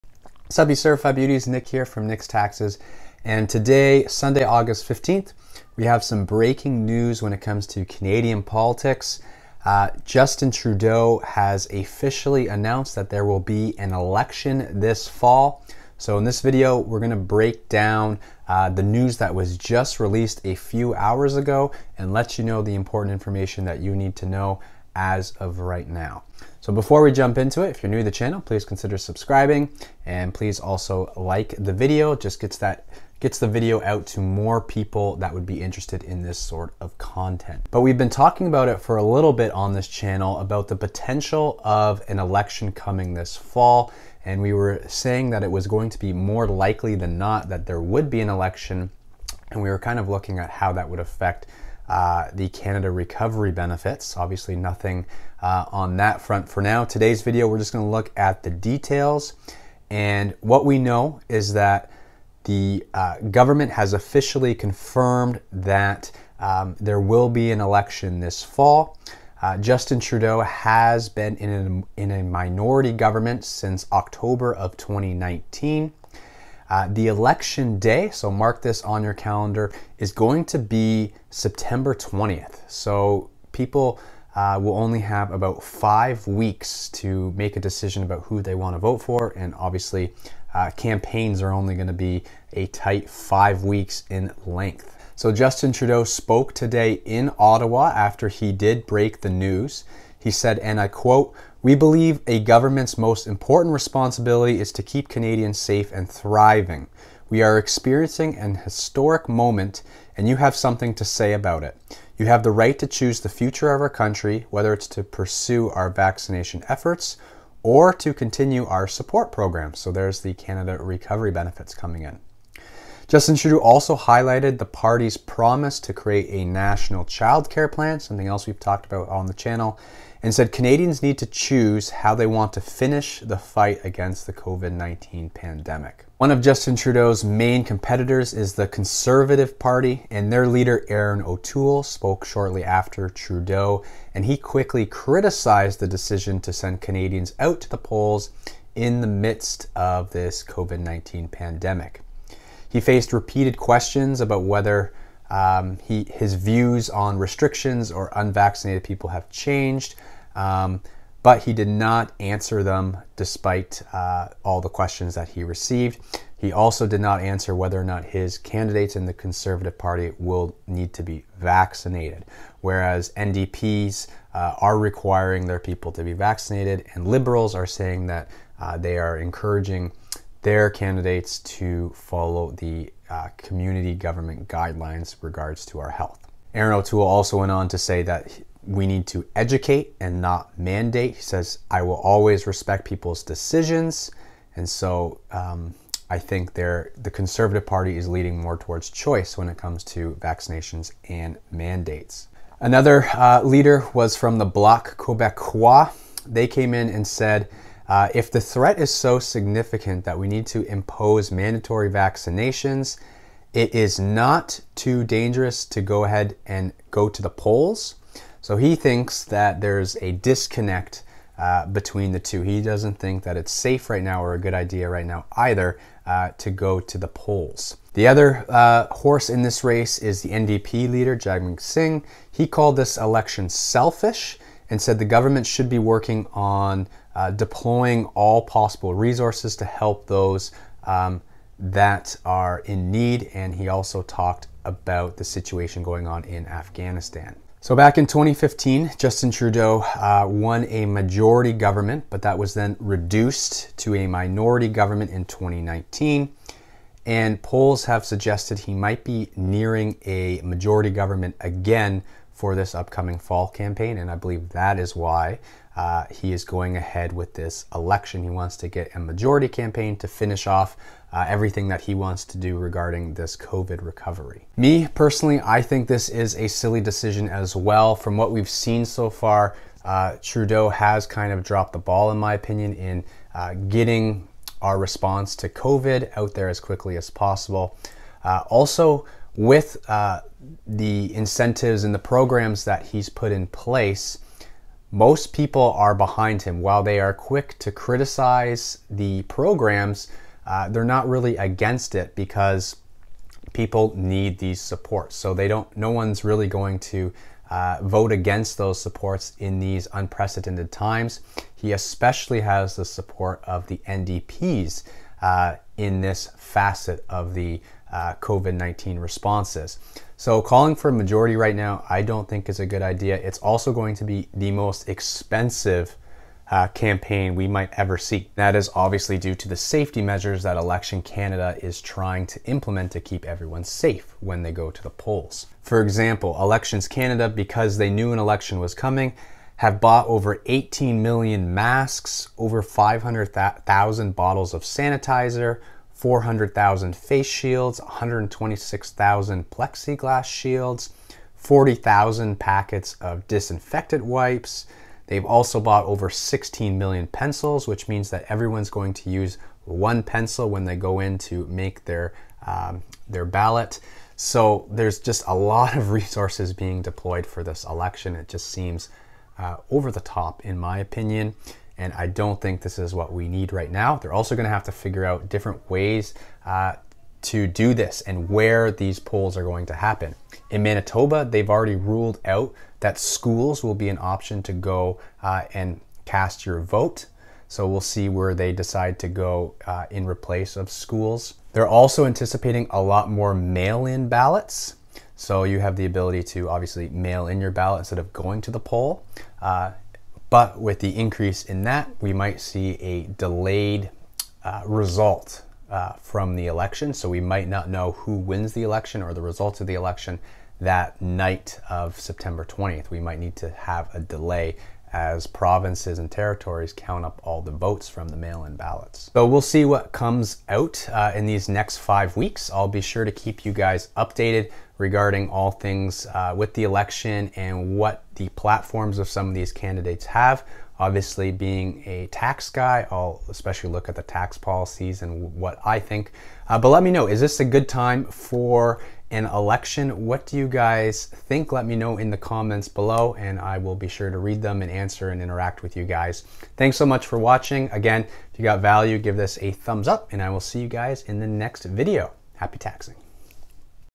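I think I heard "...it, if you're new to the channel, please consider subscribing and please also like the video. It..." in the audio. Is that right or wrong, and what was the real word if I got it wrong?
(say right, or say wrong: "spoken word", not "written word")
right.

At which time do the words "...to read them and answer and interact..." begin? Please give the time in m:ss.
7:24.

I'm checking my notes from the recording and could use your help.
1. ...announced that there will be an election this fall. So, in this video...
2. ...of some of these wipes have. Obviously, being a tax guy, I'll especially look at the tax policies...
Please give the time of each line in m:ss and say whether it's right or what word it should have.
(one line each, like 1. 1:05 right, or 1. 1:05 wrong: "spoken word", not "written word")
1. 0:12 right
2. 7:08 wrong: "candidates", not "wipes".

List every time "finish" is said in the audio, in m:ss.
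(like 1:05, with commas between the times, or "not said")
2:12, 4:30.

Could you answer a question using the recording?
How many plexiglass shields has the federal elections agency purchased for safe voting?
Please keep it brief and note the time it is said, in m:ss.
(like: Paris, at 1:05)
126,000, at 5:47.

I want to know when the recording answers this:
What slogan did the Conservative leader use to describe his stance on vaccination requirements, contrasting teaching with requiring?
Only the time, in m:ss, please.
3:09.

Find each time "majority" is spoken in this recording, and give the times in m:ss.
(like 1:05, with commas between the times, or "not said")
4:10, 4:20, 4:28, 5:20.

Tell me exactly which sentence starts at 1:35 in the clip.
So Justin Trudeau spoke today in Ottawa after he did break the news.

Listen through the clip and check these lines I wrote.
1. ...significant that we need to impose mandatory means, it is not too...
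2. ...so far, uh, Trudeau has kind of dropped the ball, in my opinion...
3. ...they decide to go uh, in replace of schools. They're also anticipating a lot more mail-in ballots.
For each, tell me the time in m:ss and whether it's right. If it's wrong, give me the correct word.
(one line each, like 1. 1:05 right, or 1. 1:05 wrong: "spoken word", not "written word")
1. 3:29 wrong: "vaccinations", not "means"
2. 4:38 right
3. 6:28 right.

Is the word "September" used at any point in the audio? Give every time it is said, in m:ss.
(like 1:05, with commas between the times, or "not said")
1:21, 6:51.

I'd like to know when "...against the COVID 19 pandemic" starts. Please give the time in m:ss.
2:13.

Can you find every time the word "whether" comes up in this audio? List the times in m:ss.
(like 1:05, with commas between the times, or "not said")
1:54, 2:34, 2:47.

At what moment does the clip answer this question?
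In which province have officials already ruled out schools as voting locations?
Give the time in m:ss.
6:20.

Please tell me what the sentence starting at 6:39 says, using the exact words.
Uh, but with the increase in that, we might see a delayed uh, result uh, from the election.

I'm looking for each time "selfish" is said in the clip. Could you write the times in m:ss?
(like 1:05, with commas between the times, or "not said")
3:53.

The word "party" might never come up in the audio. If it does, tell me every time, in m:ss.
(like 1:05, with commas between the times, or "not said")
2:04, 2:19, 2:49, 3:17.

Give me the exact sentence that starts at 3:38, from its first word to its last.
So he thinks that there's a disconnect uh, between the two.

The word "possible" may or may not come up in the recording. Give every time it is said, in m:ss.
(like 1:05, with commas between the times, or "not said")
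3:58, 4:47.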